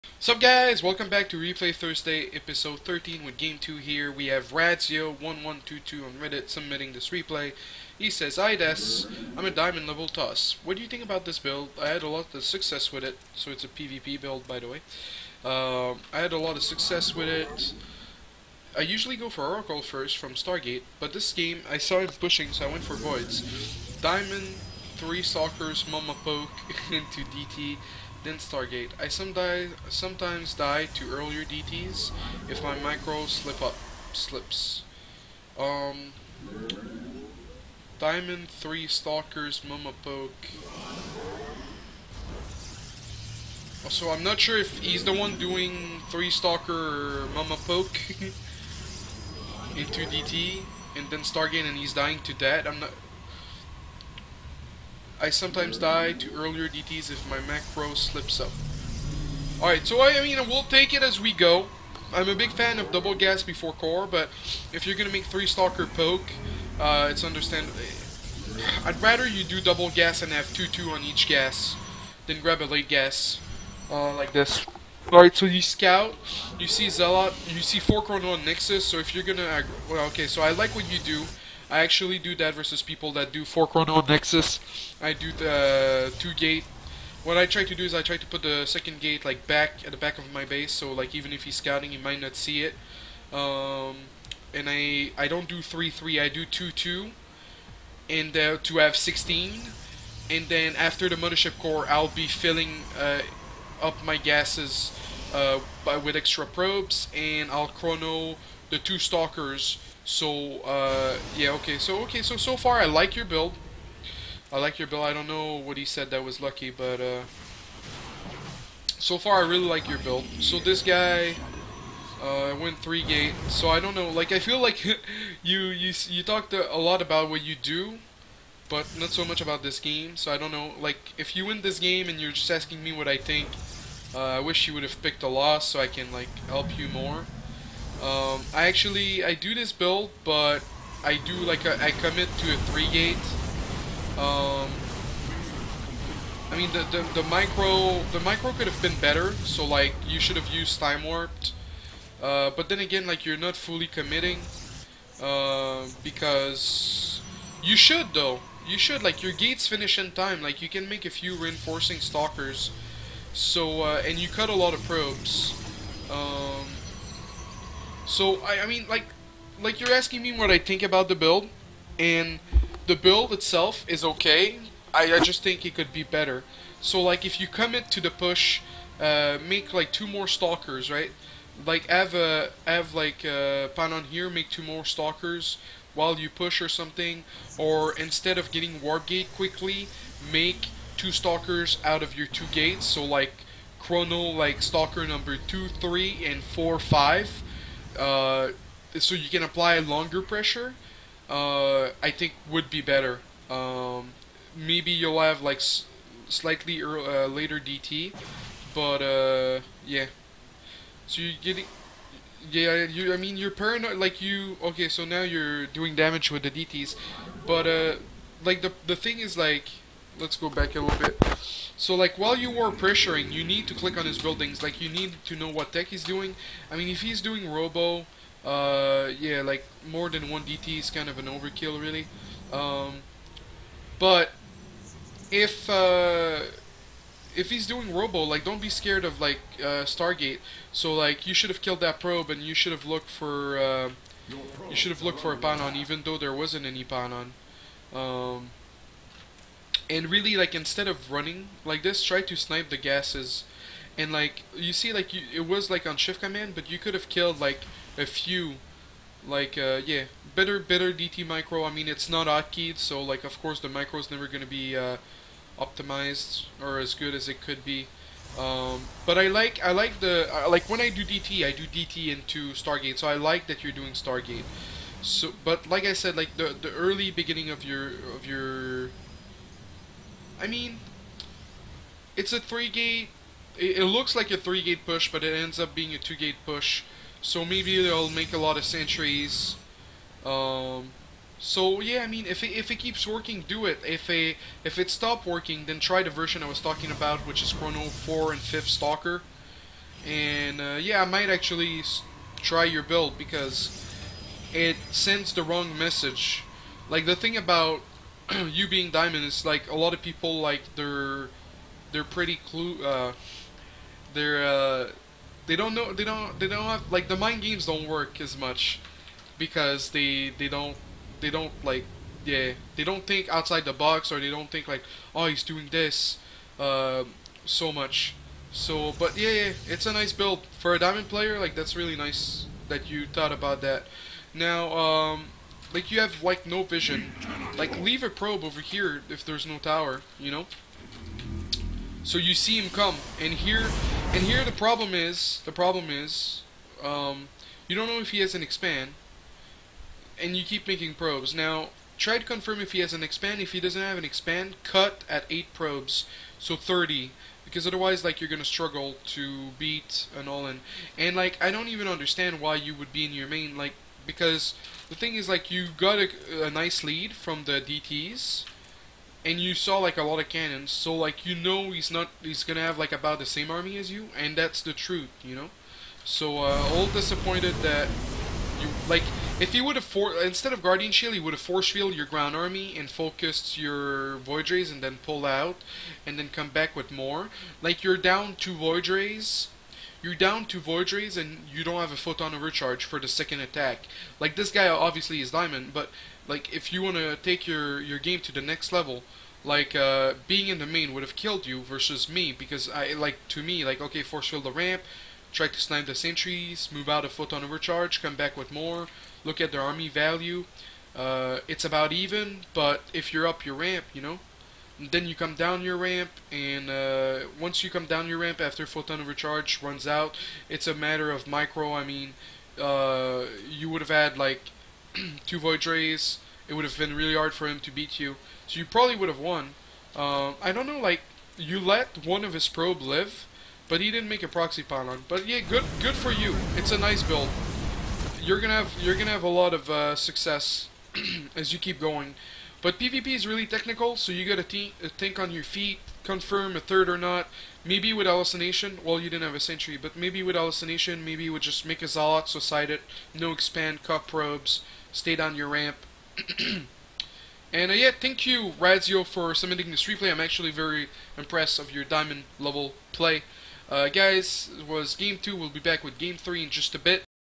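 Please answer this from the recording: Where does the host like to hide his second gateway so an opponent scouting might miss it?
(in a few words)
Back of my base.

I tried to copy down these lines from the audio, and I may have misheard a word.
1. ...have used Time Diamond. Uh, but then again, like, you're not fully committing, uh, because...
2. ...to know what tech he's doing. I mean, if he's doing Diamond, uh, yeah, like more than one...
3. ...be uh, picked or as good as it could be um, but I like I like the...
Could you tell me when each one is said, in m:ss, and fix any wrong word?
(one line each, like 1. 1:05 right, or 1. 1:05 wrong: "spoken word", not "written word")
1. 2:30 wrong: "Warped", not "Diamond"
2. 3:45 wrong: "Robo", not "Diamond"
3. 4:24 wrong: "optimized", not "picked".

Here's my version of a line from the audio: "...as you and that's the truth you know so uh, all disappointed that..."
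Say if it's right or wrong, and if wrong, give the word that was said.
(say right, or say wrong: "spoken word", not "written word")
right.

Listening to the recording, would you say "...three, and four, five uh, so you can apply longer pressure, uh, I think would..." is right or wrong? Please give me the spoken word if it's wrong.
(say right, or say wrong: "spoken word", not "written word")
right.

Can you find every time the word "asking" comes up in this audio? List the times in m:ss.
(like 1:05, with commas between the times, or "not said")
2:12, 2:49.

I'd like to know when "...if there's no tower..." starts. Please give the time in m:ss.
5:39.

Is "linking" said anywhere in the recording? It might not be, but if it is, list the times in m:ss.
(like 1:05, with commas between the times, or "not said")
not said.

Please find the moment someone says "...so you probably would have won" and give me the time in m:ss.
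7:08.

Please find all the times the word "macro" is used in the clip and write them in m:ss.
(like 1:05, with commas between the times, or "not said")
0:57.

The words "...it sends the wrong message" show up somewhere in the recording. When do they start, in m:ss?
5:04.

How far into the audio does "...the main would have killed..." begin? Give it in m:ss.
6:40.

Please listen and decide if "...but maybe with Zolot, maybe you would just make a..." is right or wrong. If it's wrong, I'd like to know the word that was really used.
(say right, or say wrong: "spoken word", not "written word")
wrong: "Hallucination", not "Zolot".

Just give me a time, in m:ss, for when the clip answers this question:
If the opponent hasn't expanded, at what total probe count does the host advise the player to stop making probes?
5:56.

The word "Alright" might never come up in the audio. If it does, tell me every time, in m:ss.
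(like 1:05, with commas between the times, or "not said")
0:59, 1:15.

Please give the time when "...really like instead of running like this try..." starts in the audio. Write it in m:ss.
4:10.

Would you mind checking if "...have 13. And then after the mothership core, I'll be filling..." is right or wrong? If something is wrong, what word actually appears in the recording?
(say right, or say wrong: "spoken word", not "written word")
wrong: "16", not "13".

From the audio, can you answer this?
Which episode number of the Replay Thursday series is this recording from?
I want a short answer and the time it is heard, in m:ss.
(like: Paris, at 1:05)
13, at 0:02.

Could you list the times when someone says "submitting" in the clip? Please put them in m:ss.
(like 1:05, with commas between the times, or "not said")
0:06, 7:39.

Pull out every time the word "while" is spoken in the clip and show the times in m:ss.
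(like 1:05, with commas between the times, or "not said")
3:05, 3:42.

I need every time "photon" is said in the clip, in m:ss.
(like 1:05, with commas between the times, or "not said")
6:31, 6:47.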